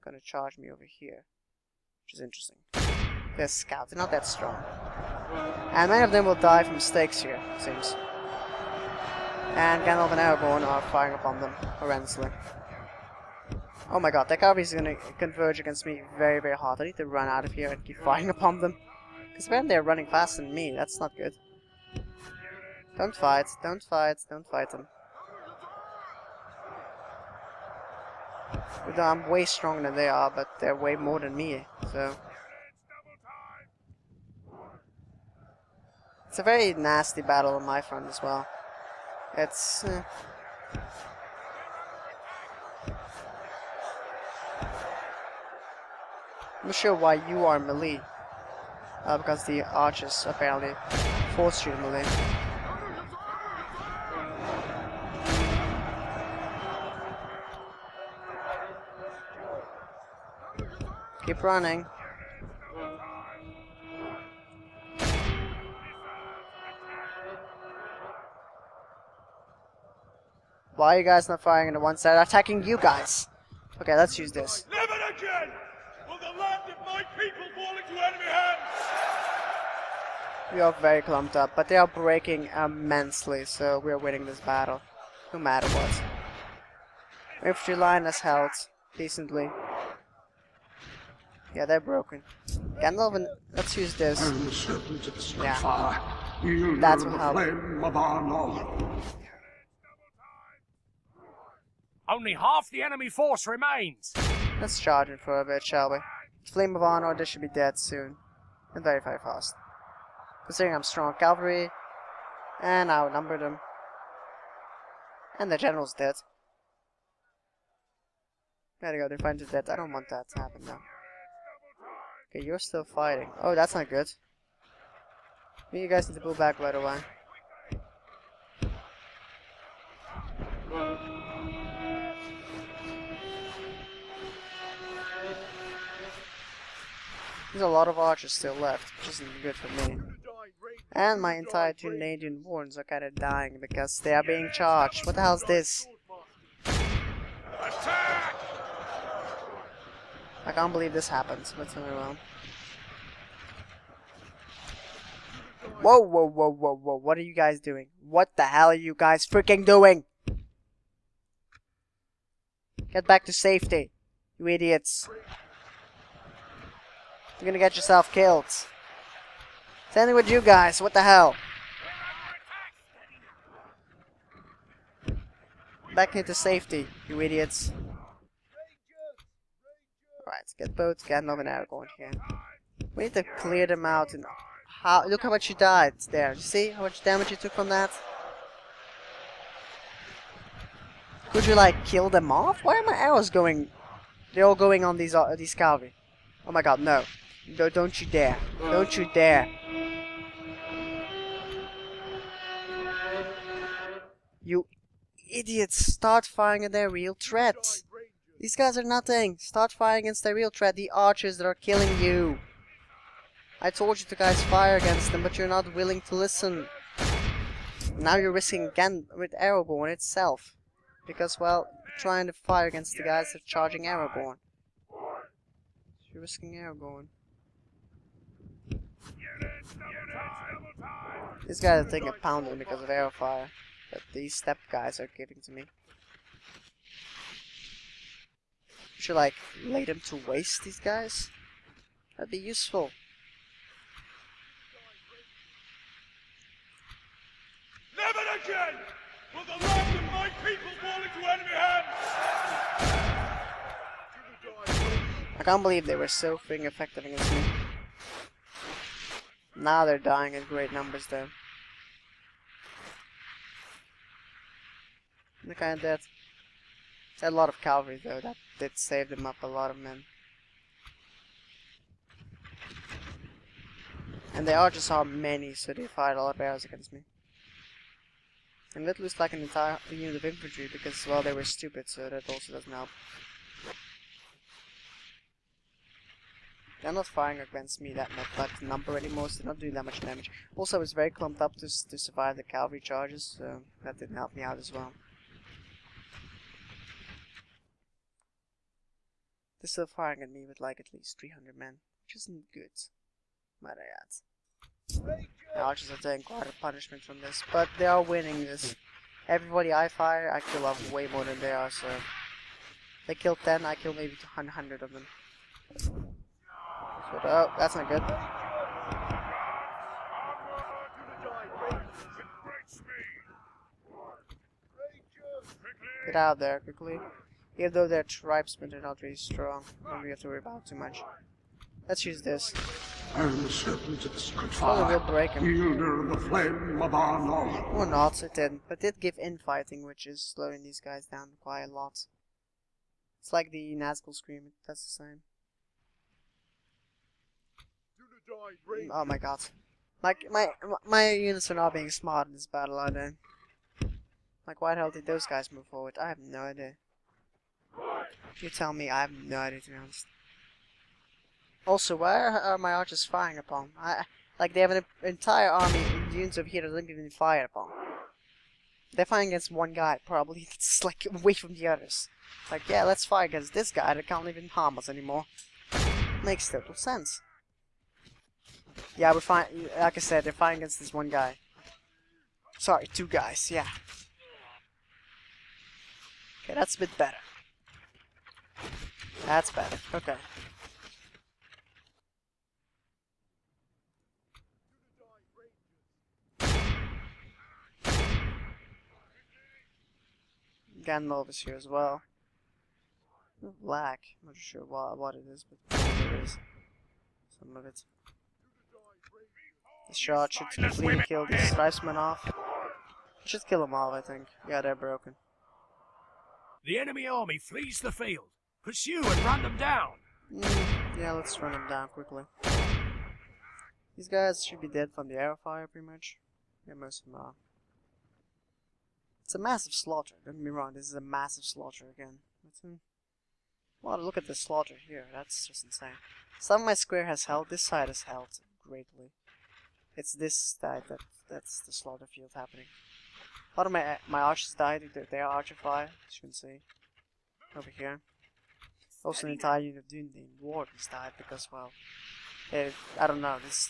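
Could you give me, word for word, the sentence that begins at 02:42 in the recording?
Get back to safety, you idiots.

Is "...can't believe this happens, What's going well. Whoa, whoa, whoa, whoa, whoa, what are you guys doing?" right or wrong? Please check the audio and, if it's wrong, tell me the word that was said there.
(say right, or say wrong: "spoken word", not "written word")
right.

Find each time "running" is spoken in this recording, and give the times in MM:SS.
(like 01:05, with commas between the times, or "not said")
00:19, 01:01.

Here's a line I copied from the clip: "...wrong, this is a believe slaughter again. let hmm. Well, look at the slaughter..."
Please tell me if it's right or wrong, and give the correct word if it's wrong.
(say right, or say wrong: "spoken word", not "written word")
wrong: "massive", not "believe".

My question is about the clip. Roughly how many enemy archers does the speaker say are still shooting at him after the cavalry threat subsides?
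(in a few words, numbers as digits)
300.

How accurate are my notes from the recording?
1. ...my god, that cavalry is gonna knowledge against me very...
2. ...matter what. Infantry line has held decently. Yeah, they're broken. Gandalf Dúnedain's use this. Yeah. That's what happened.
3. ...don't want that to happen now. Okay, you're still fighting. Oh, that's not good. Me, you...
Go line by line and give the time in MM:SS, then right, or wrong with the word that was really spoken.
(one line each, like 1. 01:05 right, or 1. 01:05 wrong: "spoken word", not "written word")
1. 00:14 wrong: "converge", not "knowledge"
2. 01:25 wrong: "Let", not "Dúnedain"
3. 01:59 right.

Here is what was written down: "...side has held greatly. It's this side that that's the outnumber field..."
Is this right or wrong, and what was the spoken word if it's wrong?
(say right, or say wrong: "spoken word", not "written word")
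wrong: "slaughter", not "outnumber".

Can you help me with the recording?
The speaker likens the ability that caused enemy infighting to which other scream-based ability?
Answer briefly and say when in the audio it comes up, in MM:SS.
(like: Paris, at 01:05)
Nazgul Scream, at 05:43.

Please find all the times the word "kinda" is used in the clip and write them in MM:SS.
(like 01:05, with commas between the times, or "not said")
02:22, 04:25.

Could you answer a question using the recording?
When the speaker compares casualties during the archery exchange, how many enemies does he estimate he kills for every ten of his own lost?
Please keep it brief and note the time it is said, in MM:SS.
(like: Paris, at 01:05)
100, at 05:14.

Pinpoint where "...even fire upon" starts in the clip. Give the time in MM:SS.
06:06.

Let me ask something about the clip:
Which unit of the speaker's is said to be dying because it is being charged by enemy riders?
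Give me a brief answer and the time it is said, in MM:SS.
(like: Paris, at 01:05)
Dúnedain wards, at 02:21.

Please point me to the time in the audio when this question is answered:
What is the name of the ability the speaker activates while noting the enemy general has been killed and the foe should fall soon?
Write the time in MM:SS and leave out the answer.
01:46.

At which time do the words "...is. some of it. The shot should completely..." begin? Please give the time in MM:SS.
06:46.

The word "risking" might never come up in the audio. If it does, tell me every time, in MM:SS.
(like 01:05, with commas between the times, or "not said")
03:38, 03:46.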